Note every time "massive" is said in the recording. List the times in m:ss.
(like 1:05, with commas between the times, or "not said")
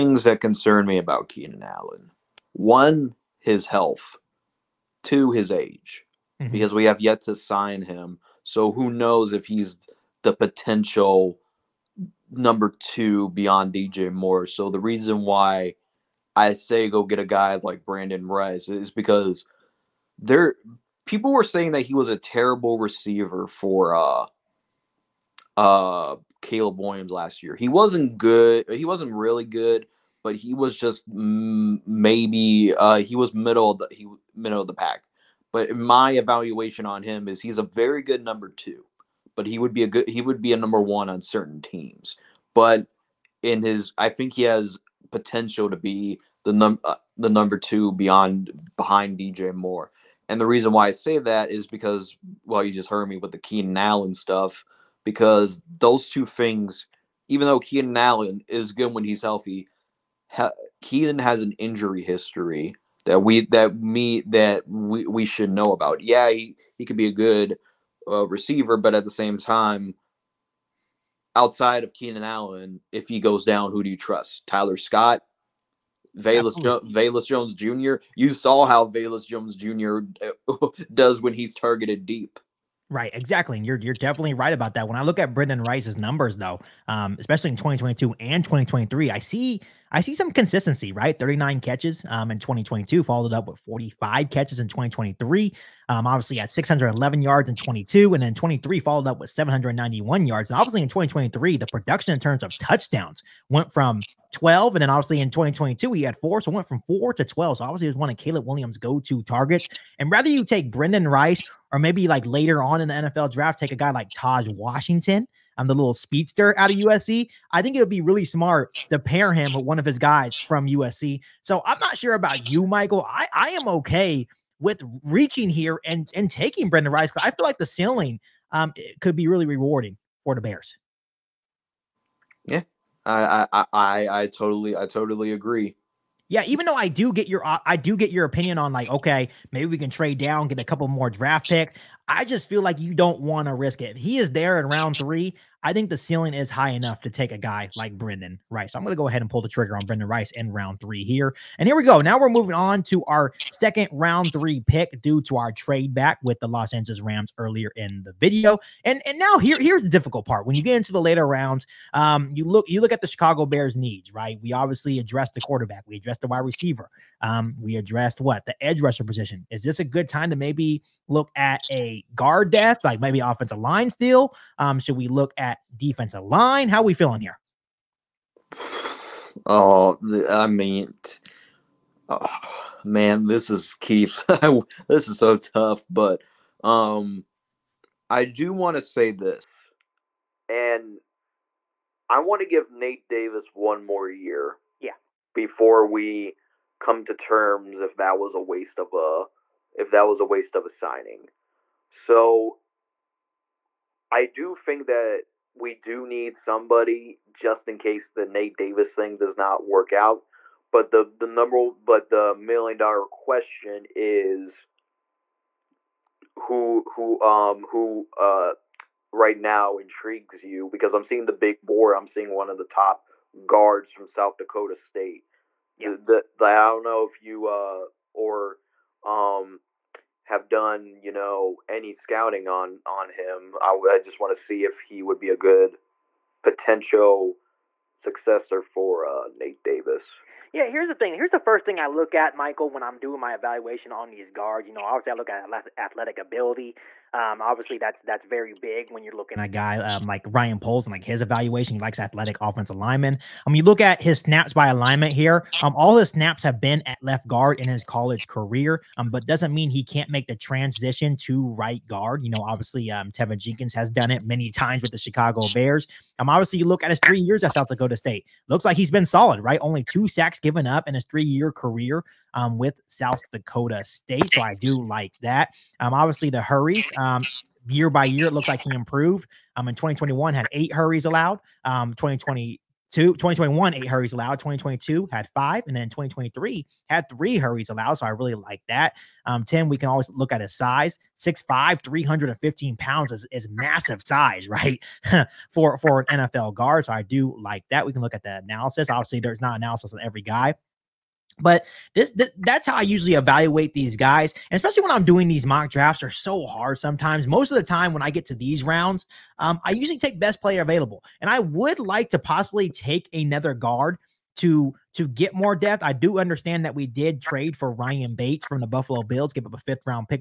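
4:53.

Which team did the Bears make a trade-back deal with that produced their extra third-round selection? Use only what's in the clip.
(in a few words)
Los Angeles Rams.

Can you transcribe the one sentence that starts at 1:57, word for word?
I think it would be really smart to pair him with one of his guys from USC.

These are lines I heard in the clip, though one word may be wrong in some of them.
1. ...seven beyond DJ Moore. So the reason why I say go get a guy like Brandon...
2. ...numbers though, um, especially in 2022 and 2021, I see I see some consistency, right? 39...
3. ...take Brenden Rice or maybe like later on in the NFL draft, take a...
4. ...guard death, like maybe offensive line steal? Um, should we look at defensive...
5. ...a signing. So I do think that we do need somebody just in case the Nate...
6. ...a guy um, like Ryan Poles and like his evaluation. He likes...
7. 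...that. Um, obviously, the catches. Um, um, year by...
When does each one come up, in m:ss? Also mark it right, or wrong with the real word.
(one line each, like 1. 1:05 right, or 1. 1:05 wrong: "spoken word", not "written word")
1. 0:12 wrong: "two", not "seven"
2. 1:25 wrong: "2023", not "2021"
3. 1:50 right
4. 2:52 right
5. 3:20 right
6. 4:09 right
7. 4:35 wrong: "hurries", not "catches".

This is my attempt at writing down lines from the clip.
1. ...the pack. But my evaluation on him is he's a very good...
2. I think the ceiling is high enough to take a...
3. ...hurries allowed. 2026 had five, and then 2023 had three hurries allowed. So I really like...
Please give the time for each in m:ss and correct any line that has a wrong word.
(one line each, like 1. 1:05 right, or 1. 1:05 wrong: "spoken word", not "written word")
1. 0:34 right
2. 2:25 right
3. 4:43 wrong: "2022", not "2026".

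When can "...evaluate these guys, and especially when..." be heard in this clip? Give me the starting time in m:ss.
5:03.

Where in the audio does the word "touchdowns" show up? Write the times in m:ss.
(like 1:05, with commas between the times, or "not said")
1:42.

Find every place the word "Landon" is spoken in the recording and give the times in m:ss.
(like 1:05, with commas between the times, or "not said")
not said.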